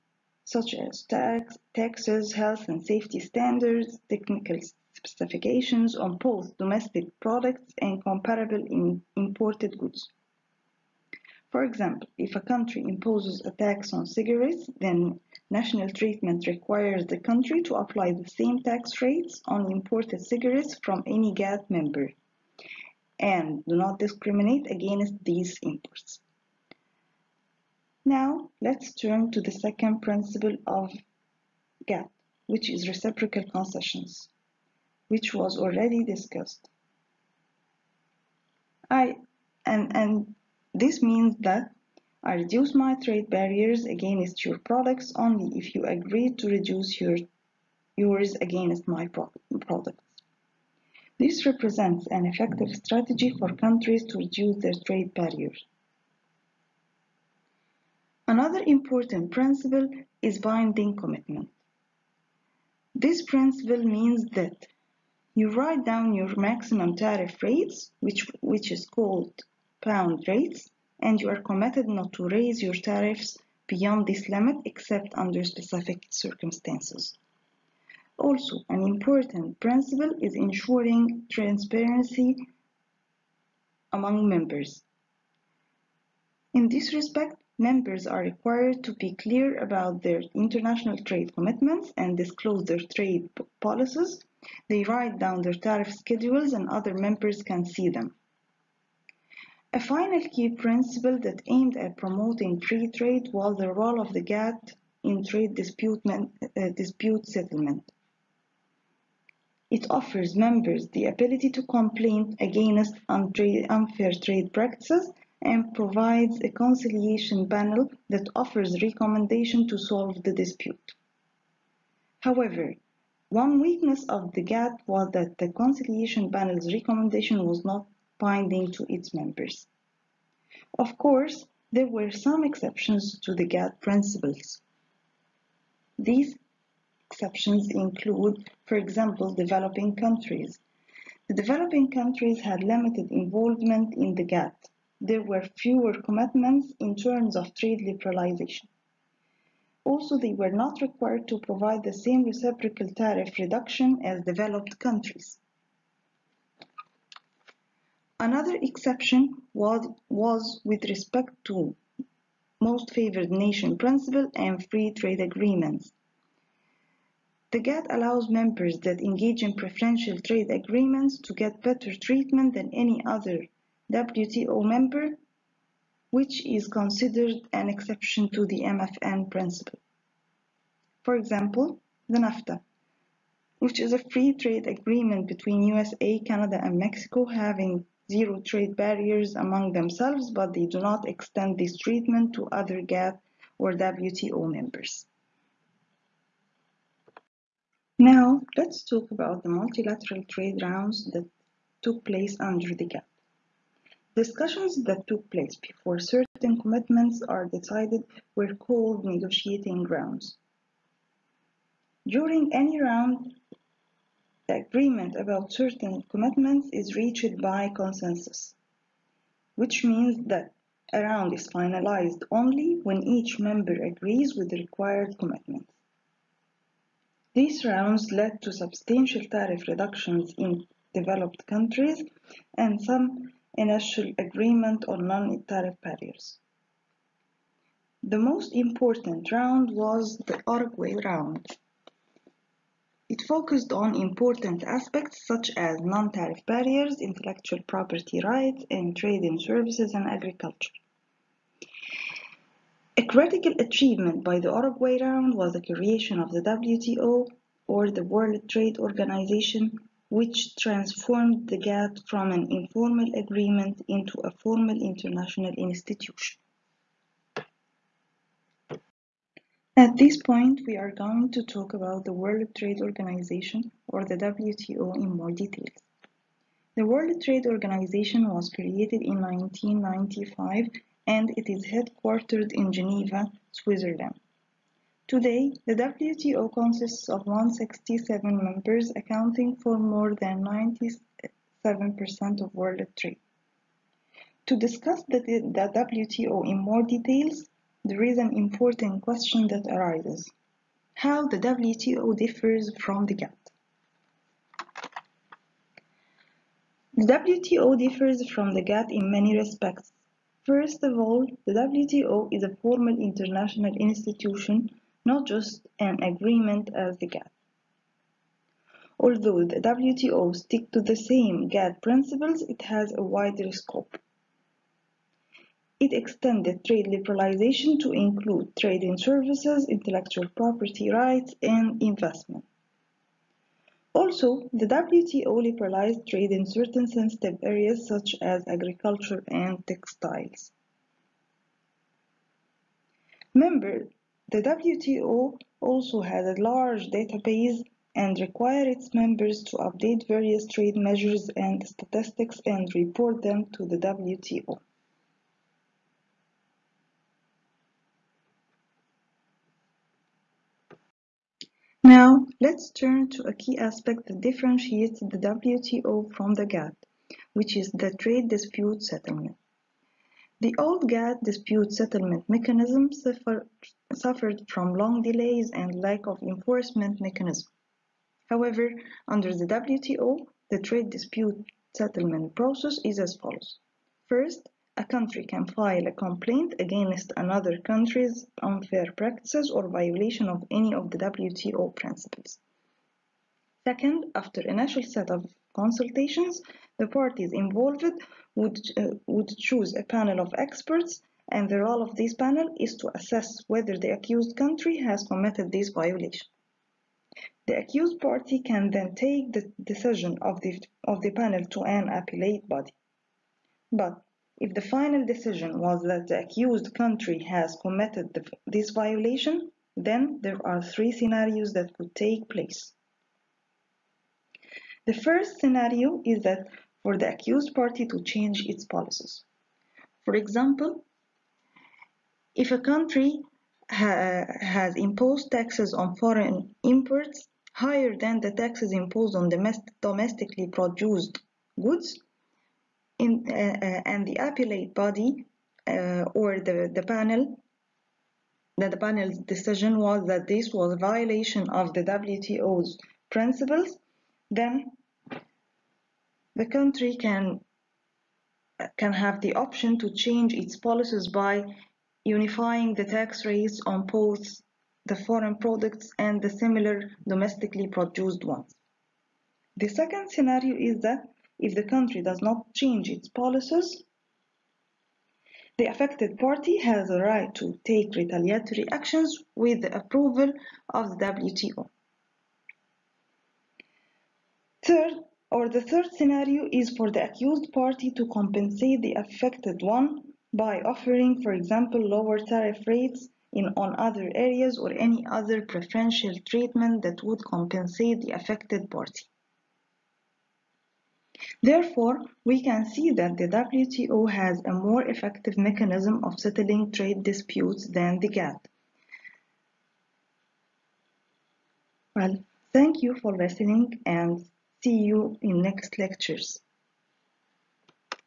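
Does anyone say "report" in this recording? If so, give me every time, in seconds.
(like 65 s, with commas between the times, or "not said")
352 s.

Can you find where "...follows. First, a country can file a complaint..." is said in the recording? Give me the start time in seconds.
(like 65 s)
383 s.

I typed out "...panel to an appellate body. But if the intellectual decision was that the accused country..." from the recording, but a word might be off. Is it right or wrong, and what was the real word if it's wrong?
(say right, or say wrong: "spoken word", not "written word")
wrong: "final", not "intellectual".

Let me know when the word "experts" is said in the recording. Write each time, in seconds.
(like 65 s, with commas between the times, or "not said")
400 s.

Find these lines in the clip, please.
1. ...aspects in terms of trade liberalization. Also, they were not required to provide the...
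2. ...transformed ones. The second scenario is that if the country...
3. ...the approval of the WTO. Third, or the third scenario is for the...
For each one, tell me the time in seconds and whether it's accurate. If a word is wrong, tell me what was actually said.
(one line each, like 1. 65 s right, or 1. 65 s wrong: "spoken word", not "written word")
1. 146 s wrong: "commitments", not "aspects"
2. 467 s wrong: "produced", not "transformed"
3. 479 s right.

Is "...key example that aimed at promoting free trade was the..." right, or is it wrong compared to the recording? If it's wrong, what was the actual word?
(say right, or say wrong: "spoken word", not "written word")
wrong: "principle", not "example".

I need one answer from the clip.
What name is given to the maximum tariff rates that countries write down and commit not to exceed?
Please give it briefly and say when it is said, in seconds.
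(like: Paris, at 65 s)
bound rates, at 69 s.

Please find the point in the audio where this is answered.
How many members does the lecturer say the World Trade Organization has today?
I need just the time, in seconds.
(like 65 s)
287 s.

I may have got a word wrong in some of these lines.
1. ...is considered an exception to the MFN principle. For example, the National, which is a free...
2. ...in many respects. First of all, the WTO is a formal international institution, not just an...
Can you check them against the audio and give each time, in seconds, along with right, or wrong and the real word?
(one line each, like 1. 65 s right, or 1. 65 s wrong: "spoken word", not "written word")
1. 176 s wrong: "NAFTA", not "National"
2. 308 s right.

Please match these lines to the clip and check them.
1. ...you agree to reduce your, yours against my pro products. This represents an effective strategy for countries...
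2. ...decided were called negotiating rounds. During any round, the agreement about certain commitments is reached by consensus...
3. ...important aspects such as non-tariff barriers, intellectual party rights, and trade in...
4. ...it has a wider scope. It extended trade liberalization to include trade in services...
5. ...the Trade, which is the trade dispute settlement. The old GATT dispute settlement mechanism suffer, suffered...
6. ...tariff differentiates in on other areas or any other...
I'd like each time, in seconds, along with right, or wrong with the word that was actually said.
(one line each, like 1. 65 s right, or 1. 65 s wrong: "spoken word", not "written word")
1. 45 s right
2. 207 s right
3. 243 s wrong: "property", not "party"
4. 322 s right
5. 366 s wrong: "GATT", not "Trade"
6. 492 s wrong: "rates", not "differentiates".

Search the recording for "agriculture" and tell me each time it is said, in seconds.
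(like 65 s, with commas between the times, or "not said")
250 s, 338 s.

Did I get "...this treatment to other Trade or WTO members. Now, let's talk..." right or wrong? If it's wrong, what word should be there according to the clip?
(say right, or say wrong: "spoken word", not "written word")
wrong: "GATT", not "Trade".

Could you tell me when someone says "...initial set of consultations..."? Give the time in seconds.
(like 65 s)
394 s.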